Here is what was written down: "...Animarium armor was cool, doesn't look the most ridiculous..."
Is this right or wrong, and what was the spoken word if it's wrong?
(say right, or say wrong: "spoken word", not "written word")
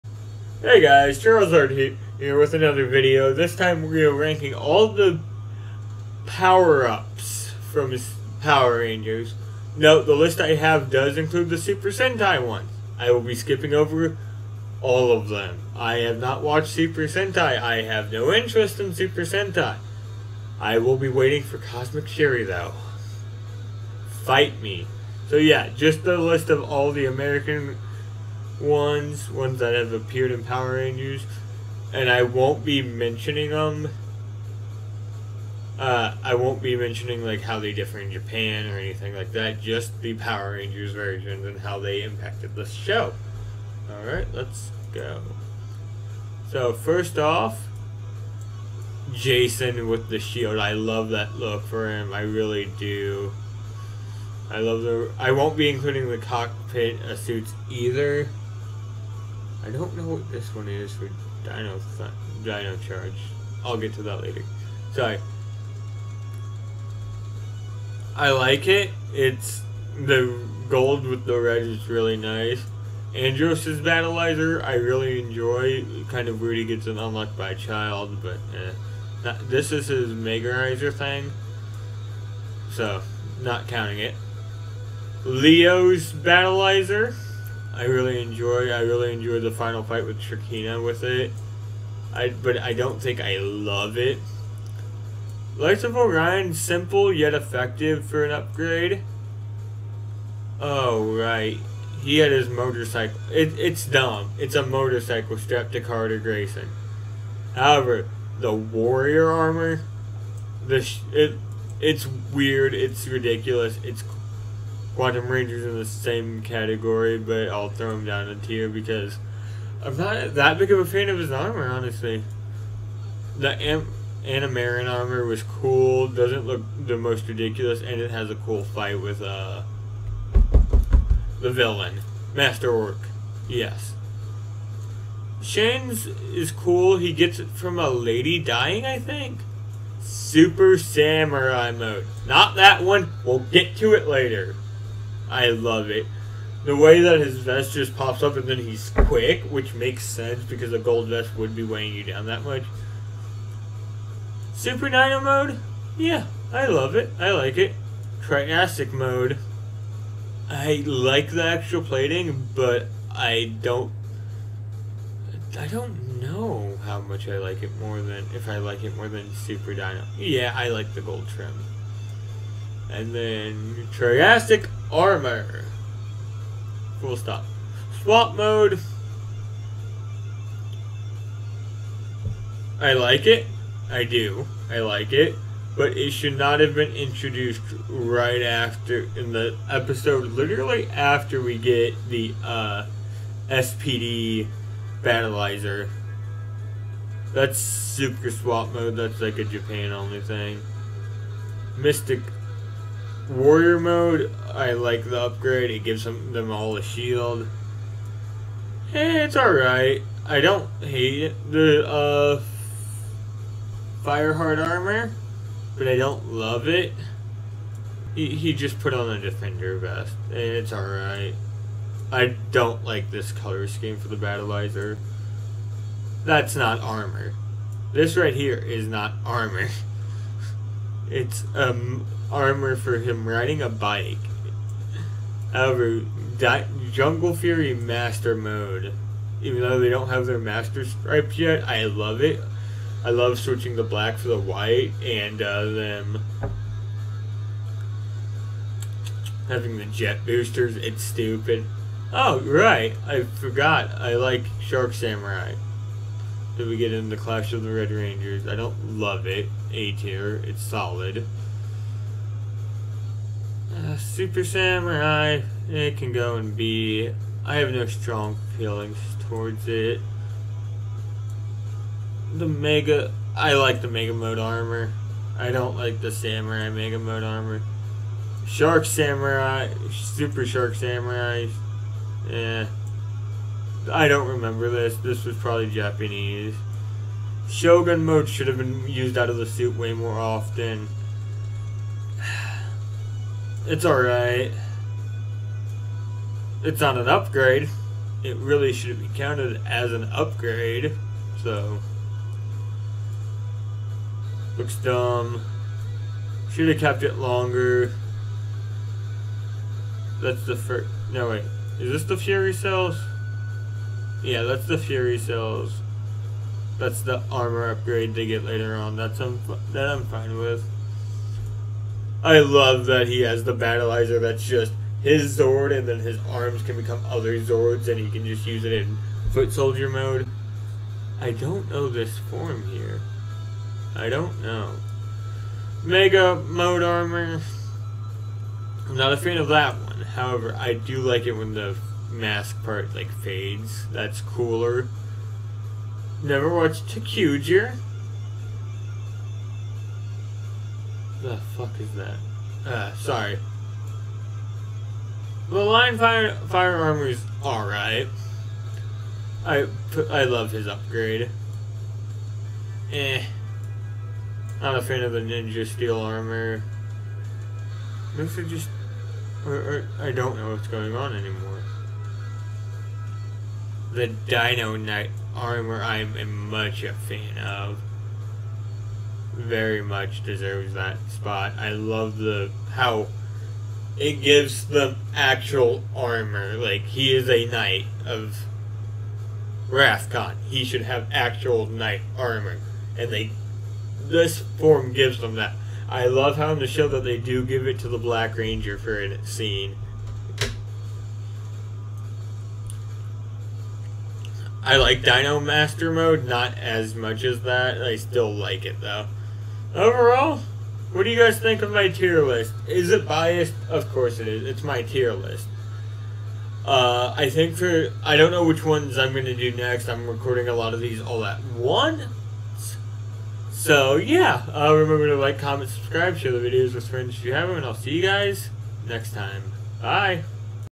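right.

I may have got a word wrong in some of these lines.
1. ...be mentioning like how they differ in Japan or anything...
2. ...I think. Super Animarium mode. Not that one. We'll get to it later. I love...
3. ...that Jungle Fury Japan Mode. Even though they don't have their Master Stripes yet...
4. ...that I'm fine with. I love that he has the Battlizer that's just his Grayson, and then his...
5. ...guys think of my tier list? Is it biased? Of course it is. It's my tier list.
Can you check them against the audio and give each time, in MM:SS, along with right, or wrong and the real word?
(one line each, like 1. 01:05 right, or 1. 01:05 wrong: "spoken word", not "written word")
1. 00:36 right
2. 02:18 wrong: "Samurai", not "Animarium"
3. 03:56 wrong: "Master", not "Japan"
4. 05:19 wrong: "Zord", not "Grayson"
5. 06:51 right.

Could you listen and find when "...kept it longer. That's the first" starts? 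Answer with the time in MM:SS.
05:06.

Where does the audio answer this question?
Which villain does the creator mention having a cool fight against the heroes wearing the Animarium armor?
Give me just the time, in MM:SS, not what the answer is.
02:12.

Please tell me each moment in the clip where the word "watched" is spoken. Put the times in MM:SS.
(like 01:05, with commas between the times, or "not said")
00:16, 05:46.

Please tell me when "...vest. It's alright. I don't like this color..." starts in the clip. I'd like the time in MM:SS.
03:39.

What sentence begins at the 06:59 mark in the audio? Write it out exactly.
I'm recording a lot of these all at once.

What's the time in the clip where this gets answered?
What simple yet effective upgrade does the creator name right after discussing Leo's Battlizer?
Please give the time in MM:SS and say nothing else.
01:35.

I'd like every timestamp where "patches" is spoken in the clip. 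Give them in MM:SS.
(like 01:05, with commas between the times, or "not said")
not said.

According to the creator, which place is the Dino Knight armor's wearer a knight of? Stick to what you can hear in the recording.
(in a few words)
Rafkon.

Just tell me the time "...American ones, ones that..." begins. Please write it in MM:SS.
00:27.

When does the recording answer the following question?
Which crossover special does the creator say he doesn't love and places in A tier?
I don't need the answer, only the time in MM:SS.
04:17.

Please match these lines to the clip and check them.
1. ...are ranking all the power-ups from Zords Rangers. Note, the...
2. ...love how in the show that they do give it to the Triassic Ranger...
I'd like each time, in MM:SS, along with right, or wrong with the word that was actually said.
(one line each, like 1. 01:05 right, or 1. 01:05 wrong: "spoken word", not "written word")
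1. 00:04 wrong: "Power", not "Zords"
2. 06:36 wrong: "Black", not "Triassic".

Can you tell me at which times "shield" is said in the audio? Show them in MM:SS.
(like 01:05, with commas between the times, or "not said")
00:50, 03:26.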